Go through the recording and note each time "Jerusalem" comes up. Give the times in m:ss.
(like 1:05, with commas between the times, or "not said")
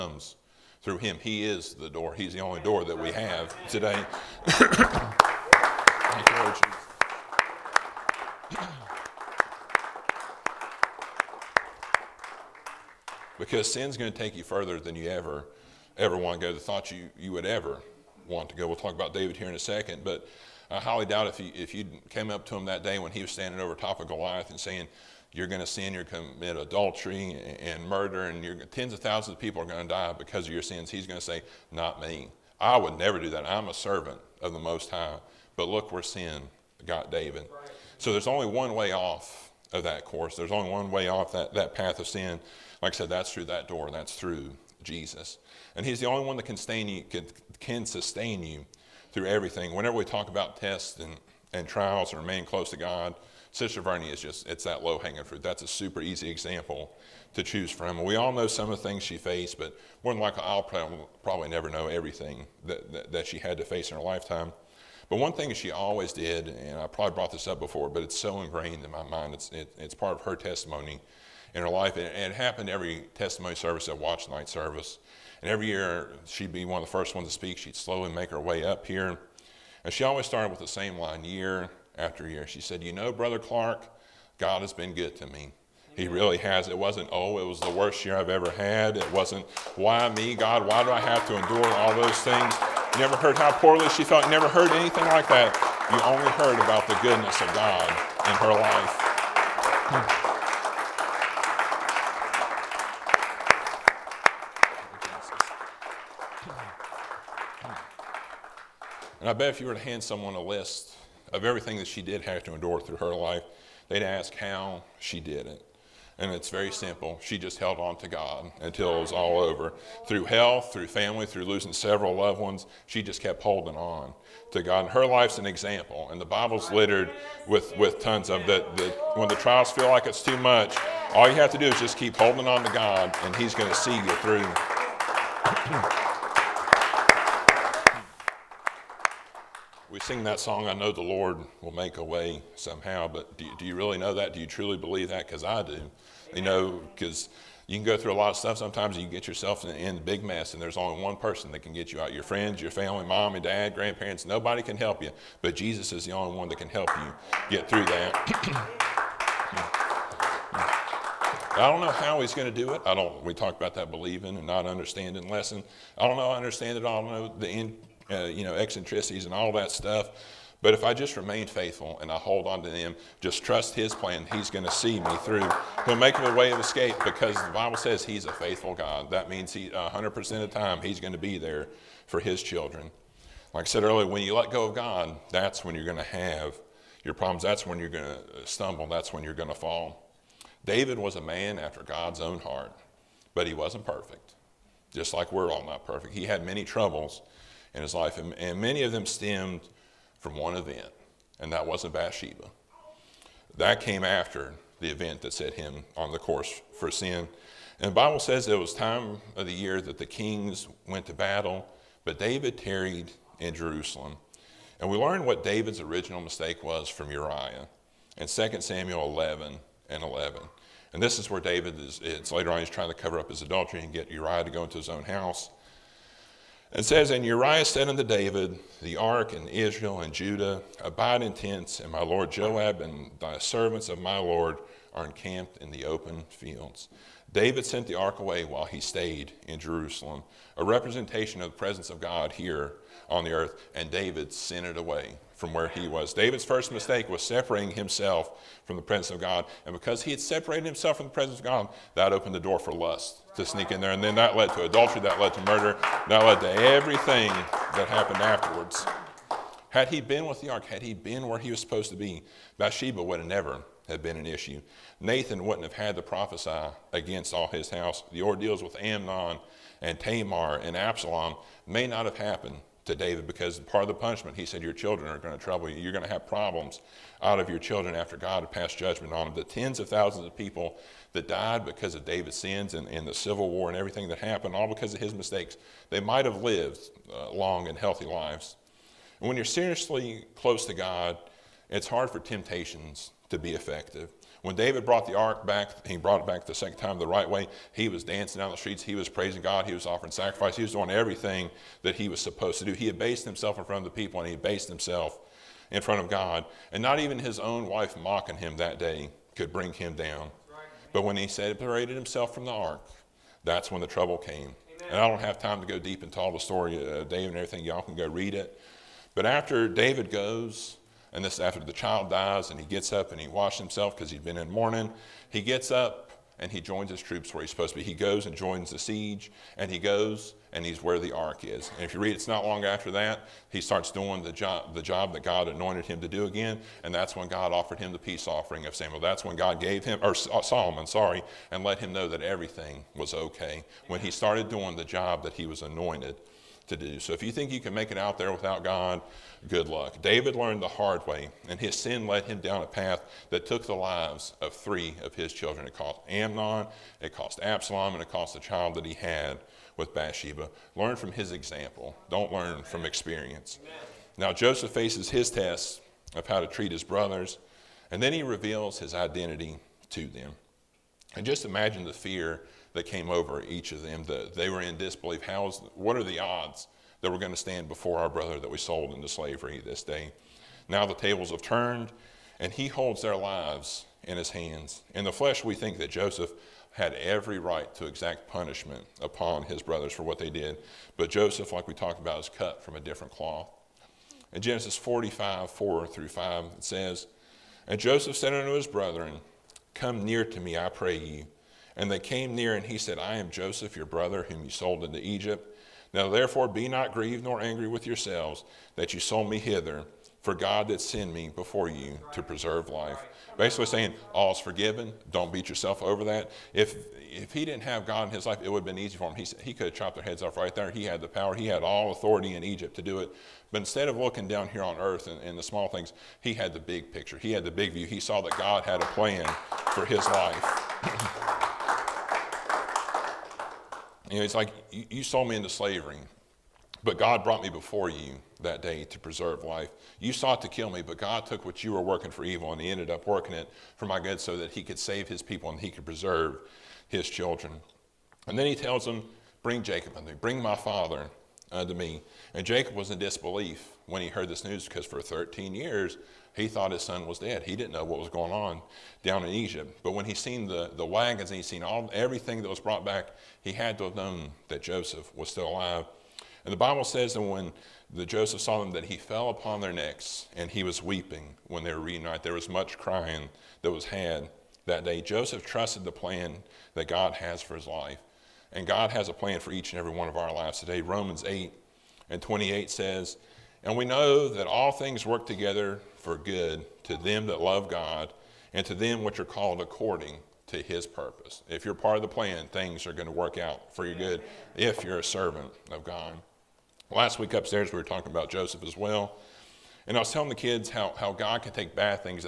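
3:33, 3:59.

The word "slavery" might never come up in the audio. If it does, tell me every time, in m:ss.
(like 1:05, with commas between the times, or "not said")
6:19, 7:15.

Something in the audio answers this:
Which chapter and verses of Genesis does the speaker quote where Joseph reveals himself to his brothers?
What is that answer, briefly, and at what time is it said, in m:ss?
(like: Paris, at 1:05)
Genesis 45:4-5, at 6:34.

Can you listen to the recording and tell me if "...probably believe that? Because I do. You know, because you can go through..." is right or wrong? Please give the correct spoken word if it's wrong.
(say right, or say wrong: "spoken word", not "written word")
wrong: "truly", not "probably".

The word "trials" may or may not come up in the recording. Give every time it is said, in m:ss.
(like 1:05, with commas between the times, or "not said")
0:51, 2:09.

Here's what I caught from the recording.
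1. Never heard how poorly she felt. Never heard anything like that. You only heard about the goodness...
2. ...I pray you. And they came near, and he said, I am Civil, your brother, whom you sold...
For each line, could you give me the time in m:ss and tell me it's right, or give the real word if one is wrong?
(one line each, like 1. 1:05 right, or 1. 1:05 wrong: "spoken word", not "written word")
1. 1:32 right
2. 6:40 wrong: "Joseph", not "Civil".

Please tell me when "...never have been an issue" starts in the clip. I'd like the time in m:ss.
4:23.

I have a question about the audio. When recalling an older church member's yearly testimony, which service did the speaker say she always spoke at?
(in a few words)
Watch Night service.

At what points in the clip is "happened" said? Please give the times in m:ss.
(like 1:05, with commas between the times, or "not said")
1:12, 4:17, 4:32, 4:44.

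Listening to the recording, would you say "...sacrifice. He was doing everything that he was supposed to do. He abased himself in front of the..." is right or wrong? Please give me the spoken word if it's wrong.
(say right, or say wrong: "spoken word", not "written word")
right.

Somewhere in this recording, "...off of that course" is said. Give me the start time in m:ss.
0:38.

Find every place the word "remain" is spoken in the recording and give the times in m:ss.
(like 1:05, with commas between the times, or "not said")
0:52, 2:51.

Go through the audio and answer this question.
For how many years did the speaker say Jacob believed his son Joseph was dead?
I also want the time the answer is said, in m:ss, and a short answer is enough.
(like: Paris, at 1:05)
13, at 7:34.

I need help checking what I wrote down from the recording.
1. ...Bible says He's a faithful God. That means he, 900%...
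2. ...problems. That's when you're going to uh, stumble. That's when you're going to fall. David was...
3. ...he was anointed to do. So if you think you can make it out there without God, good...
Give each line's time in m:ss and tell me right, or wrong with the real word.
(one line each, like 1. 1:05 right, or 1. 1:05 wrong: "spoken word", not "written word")
1. 2:57 wrong: "100", not "900"
2. 3:07 right
3. 5:45 right.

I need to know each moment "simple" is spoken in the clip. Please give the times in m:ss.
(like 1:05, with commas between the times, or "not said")
1:56.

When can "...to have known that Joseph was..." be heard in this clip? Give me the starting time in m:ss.
7:43.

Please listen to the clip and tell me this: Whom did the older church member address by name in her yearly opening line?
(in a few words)
Brother Clark.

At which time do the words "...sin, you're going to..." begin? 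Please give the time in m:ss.
0:25.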